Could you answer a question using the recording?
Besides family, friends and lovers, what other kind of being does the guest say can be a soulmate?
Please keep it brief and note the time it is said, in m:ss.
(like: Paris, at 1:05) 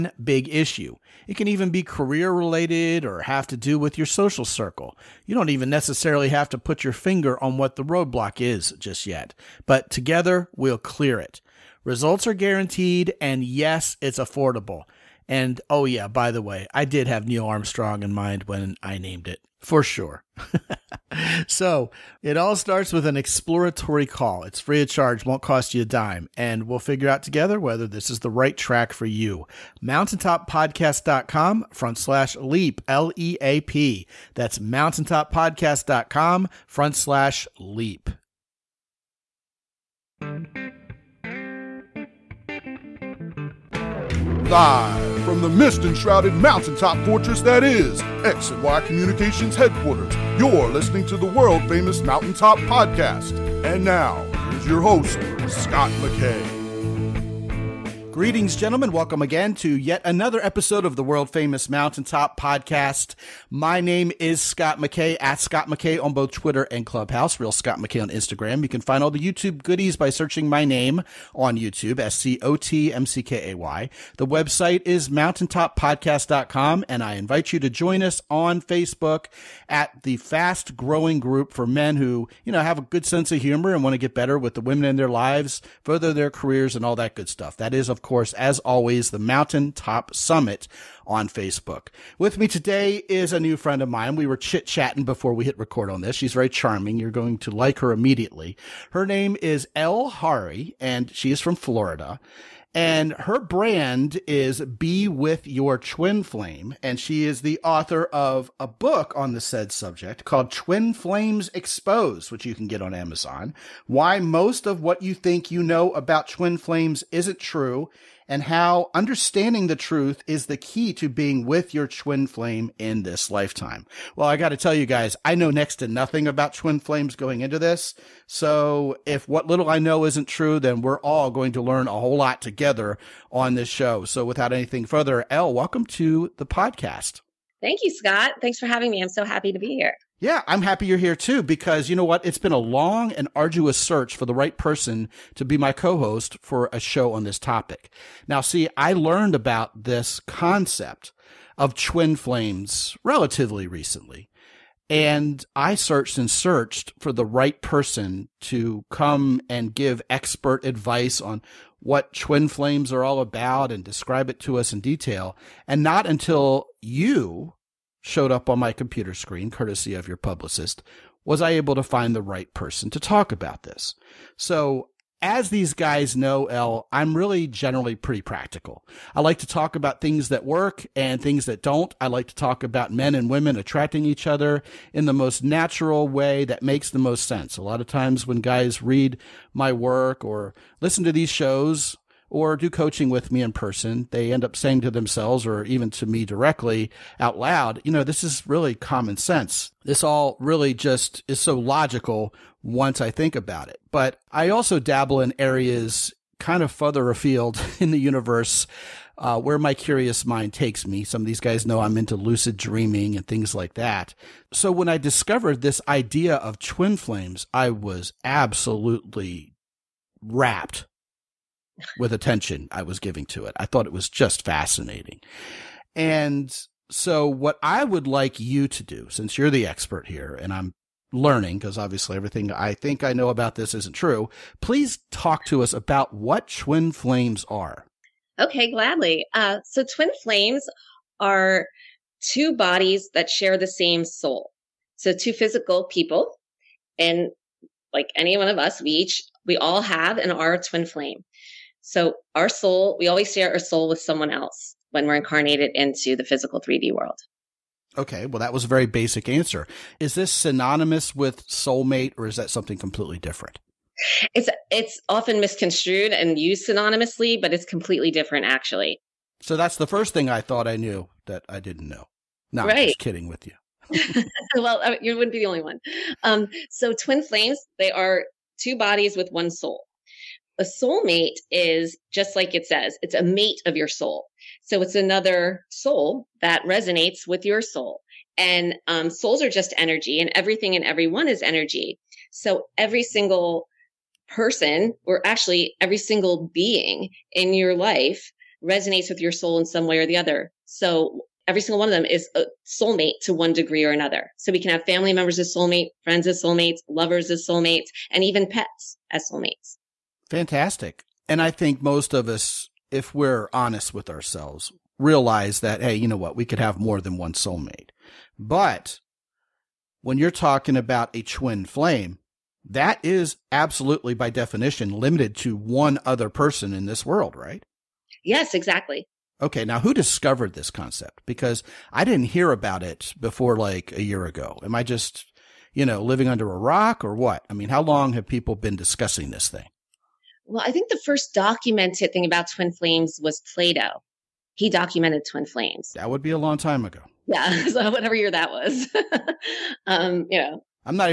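pets, at 5:08.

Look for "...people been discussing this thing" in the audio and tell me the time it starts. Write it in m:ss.
5:38.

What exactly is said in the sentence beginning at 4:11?
So our soul, we always share our soul with someone else when we're incarnated into the physical 3D world.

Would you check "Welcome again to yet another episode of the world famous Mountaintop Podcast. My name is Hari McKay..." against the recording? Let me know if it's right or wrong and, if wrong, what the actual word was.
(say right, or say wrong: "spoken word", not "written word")
wrong: "Scot", not "Hari".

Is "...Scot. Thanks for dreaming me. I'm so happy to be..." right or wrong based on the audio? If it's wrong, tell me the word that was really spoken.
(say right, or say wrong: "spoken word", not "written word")
wrong: "having", not "dreaming".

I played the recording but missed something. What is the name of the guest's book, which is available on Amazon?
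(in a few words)
Twin Flames Exposed.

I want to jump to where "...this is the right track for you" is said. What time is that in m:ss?
0:27.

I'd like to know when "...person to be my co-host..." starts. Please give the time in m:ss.
2:24.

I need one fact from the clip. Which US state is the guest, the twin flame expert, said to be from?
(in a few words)
Florida.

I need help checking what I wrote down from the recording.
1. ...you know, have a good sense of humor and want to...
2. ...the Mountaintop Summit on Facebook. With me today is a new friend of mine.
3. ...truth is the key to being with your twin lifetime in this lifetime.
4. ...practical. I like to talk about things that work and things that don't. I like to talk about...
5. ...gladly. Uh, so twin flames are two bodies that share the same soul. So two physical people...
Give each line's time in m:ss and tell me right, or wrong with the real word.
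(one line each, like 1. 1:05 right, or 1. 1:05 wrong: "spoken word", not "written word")
1. 1:22 right
2. 1:29 right
3. 1:59 wrong: "flame", not "lifetime"
4. 2:58 right
5. 3:58 right.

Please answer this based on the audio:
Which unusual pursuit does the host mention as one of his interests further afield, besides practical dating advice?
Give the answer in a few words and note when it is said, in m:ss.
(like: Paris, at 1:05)
lucid dreaming, at 3:32.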